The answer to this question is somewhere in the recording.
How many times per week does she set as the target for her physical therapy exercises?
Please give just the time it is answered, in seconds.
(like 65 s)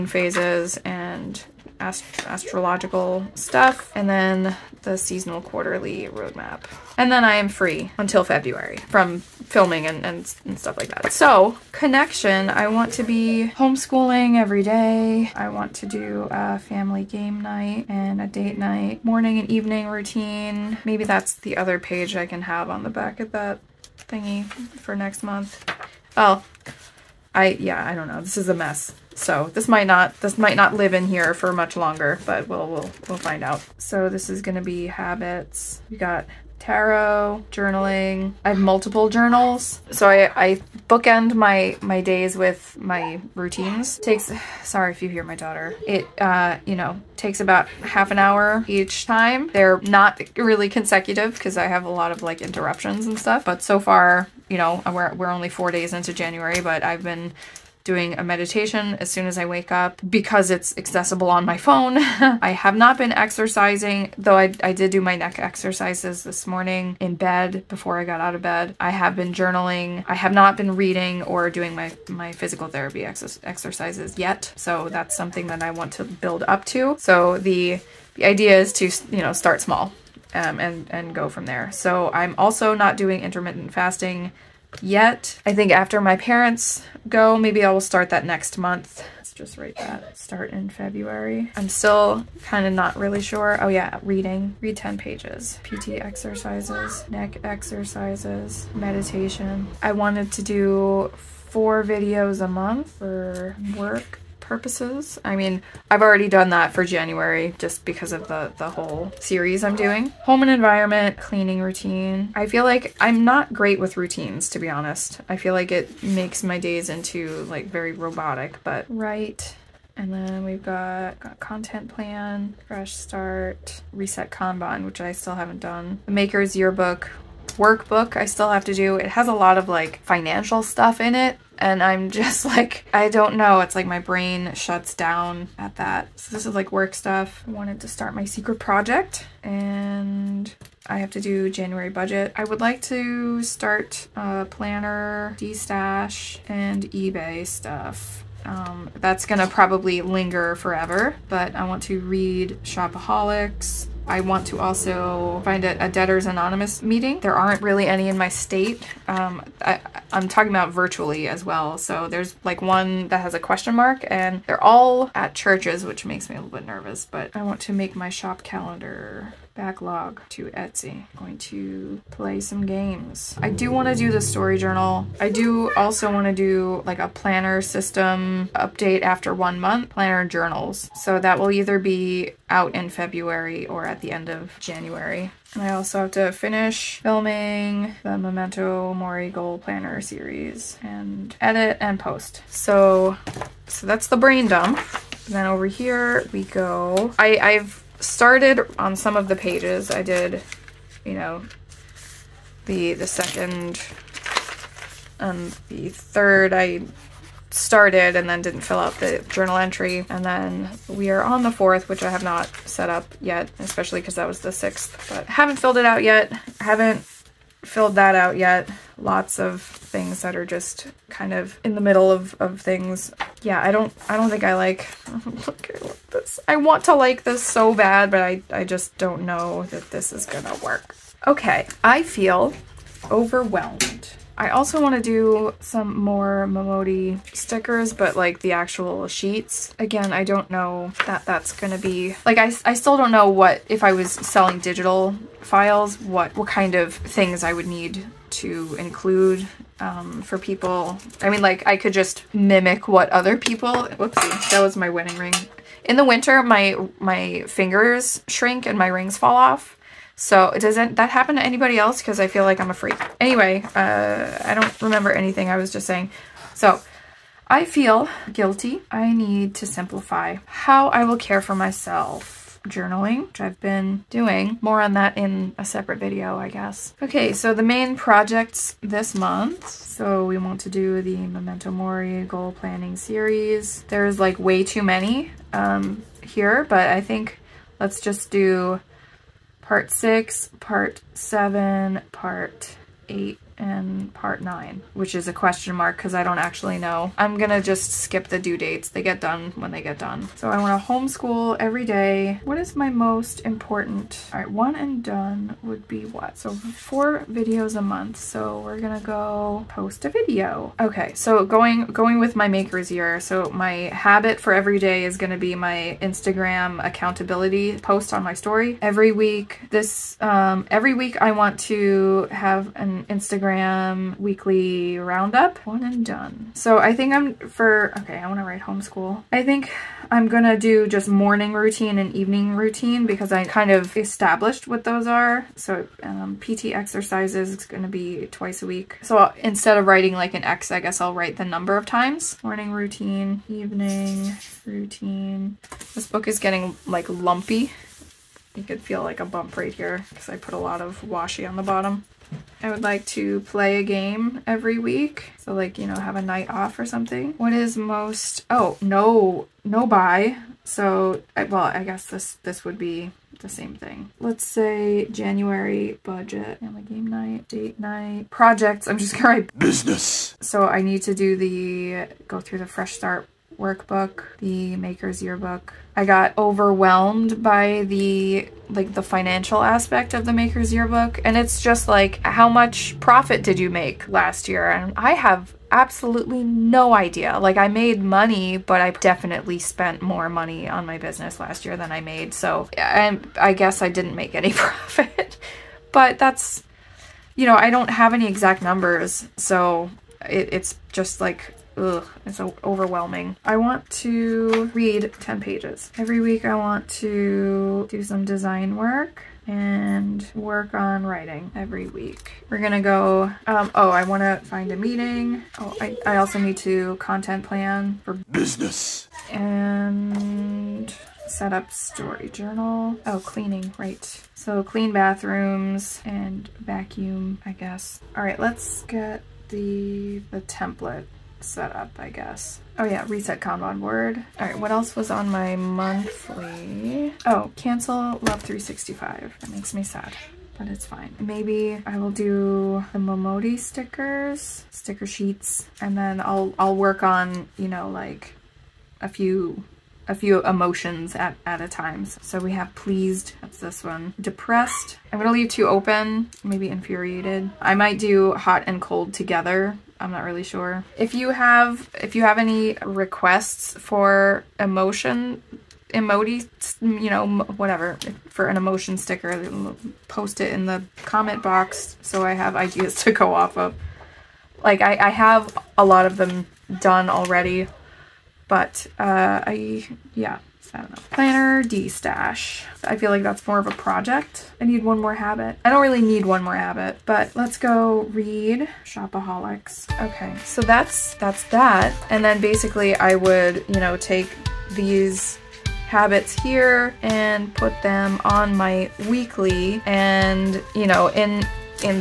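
338 s.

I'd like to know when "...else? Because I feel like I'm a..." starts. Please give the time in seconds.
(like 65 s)
261 s.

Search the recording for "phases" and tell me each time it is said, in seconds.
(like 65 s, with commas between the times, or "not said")
0 s.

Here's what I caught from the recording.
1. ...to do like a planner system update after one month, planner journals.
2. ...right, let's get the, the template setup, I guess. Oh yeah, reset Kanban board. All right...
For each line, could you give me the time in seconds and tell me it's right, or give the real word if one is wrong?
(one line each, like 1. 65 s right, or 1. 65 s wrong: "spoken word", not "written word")
1. 176 s right
2. 428 s right.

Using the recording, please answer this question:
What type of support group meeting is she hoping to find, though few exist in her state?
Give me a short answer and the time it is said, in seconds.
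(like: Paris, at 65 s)
Debtors Anonymous, at 155 s.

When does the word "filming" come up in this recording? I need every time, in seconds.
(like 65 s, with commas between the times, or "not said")
9 s, 187 s.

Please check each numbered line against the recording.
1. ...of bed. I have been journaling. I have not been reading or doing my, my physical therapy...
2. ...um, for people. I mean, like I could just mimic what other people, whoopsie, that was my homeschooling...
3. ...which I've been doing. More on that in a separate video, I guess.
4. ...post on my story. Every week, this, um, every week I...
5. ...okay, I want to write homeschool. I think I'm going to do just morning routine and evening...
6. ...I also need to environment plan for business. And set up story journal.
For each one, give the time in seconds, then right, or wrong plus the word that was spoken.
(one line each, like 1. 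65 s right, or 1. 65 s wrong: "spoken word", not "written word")
1. 68 s right
2. 249 s wrong: "wedding", not "homeschooling"
3. 273 s right
4. 317 s right
5. 327 s right
6. 416 s wrong: "content", not "environment".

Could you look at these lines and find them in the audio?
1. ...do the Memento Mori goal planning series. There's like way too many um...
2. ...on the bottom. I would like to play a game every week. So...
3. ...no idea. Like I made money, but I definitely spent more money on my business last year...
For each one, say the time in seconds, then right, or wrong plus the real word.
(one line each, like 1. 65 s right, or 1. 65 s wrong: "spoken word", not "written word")
1. 280 s right
2. 351 s right
3. 386 s right.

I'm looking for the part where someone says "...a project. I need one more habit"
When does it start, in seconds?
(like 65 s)
483 s.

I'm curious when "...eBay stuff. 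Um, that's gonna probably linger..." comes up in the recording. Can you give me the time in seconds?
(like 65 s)
146 s.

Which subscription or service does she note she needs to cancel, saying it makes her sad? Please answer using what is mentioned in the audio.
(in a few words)
Love 365.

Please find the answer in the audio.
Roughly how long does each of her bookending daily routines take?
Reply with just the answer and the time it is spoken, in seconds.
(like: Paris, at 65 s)
half an hour, at 47 s.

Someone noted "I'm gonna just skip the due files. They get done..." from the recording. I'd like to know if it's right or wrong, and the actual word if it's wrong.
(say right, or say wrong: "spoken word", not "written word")
wrong: "dates", not "files".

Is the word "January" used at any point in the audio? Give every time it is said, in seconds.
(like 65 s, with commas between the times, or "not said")
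56 s, 106 s, 141 s, 184 s, 365 s.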